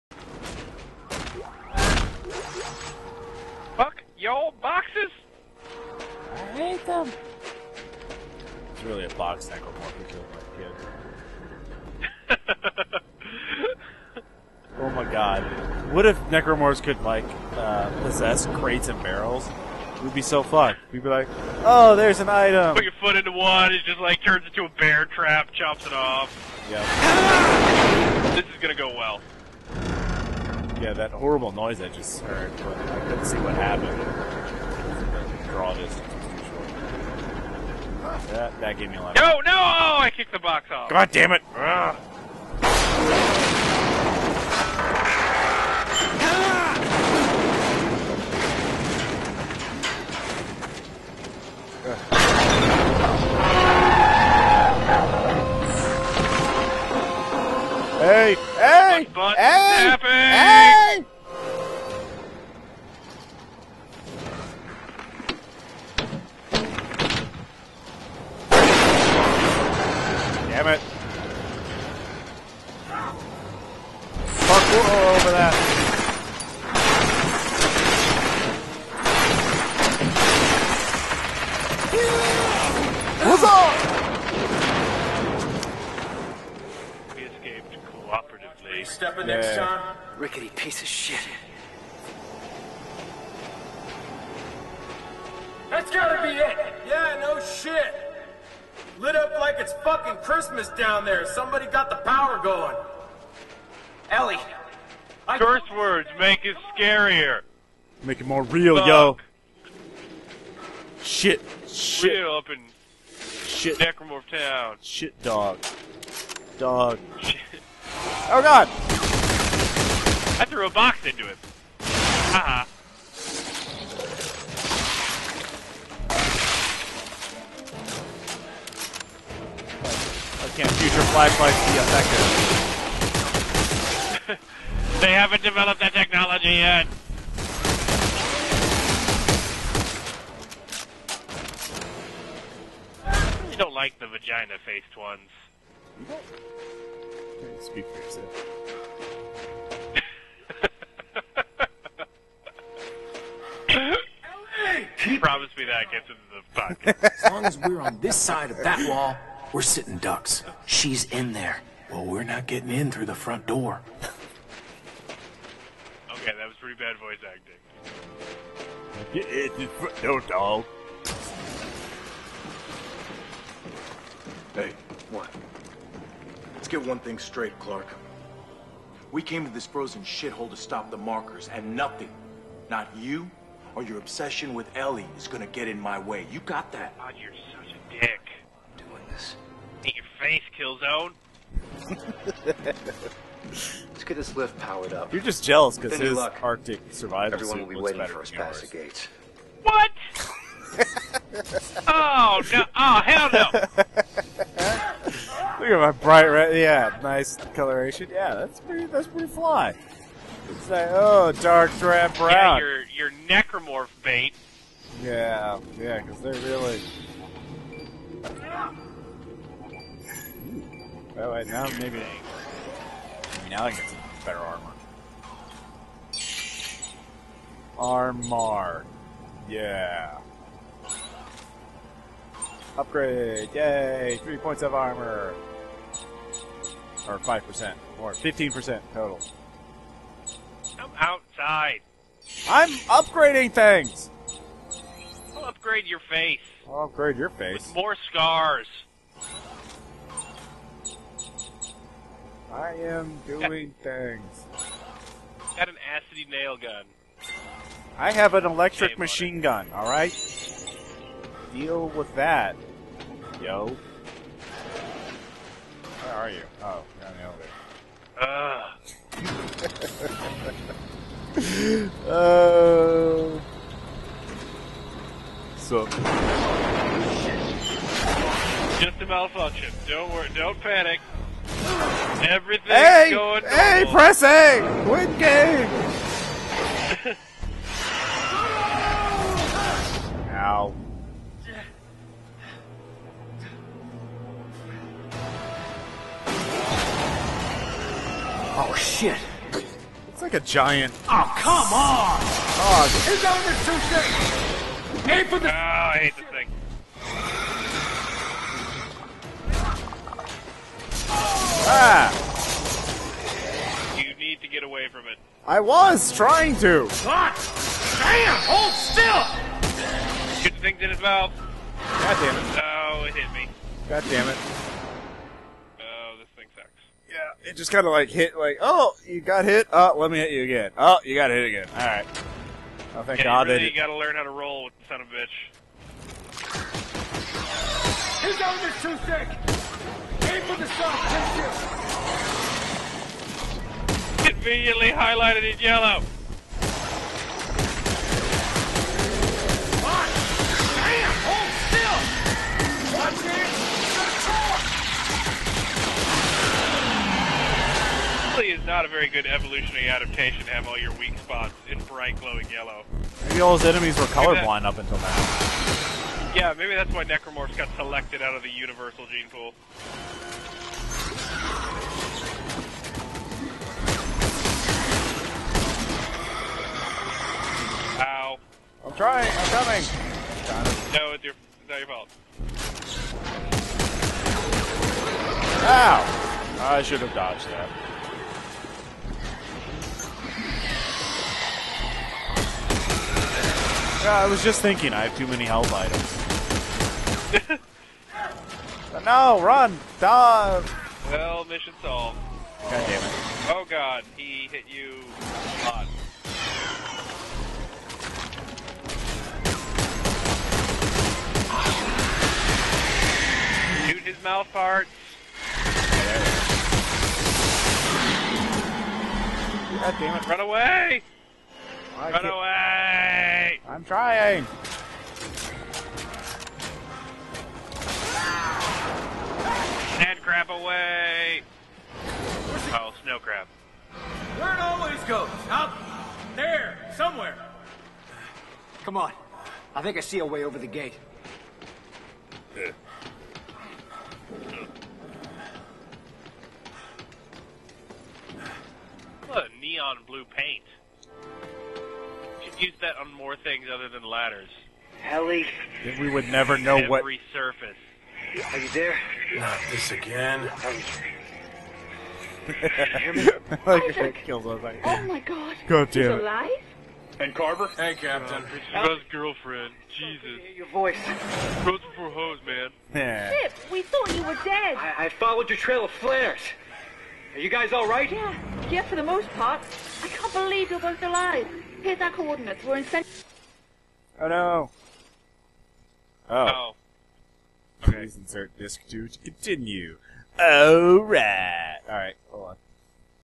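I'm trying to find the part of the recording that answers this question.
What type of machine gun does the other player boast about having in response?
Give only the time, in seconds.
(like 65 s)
258 s.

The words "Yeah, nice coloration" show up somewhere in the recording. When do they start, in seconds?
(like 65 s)
206 s.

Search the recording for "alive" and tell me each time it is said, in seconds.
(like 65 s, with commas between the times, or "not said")
466 s, 481 s.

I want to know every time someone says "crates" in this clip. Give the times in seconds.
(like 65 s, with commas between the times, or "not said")
18 s.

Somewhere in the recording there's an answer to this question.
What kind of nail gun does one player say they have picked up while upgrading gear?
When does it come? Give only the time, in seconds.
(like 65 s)
255 s.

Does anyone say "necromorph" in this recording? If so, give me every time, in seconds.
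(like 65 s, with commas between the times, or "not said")
9 s, 16 s, 113 s, 213 s, 367 s.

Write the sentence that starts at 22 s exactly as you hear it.
Put your foot into one, it just, like, turns into a bear trap, chops it off.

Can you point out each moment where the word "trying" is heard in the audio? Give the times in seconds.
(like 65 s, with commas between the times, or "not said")
316 s, 378 s, 423 s.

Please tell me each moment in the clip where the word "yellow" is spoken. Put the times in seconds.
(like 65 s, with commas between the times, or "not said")
345 s, 362 s.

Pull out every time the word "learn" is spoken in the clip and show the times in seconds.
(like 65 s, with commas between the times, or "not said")
333 s.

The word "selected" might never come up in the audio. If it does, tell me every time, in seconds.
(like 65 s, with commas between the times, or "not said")
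367 s.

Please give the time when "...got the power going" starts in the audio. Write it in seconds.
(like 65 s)
101 s.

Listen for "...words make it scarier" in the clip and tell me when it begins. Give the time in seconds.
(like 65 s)
105 s.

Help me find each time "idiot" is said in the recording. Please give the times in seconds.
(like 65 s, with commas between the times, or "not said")
not said.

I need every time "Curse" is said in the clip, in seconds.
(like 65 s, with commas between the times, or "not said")
105 s.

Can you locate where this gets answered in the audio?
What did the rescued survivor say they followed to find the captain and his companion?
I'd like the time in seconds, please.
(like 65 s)
475 s.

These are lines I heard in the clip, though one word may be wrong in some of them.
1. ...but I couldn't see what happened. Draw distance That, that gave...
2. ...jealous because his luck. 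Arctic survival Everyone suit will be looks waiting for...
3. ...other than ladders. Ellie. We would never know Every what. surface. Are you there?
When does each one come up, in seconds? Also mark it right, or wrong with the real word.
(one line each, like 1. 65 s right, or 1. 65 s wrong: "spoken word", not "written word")
1. 32 s right
2. 195 s right
3. 453 s right.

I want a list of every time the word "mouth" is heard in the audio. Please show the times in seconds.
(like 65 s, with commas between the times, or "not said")
321 s, 414 s.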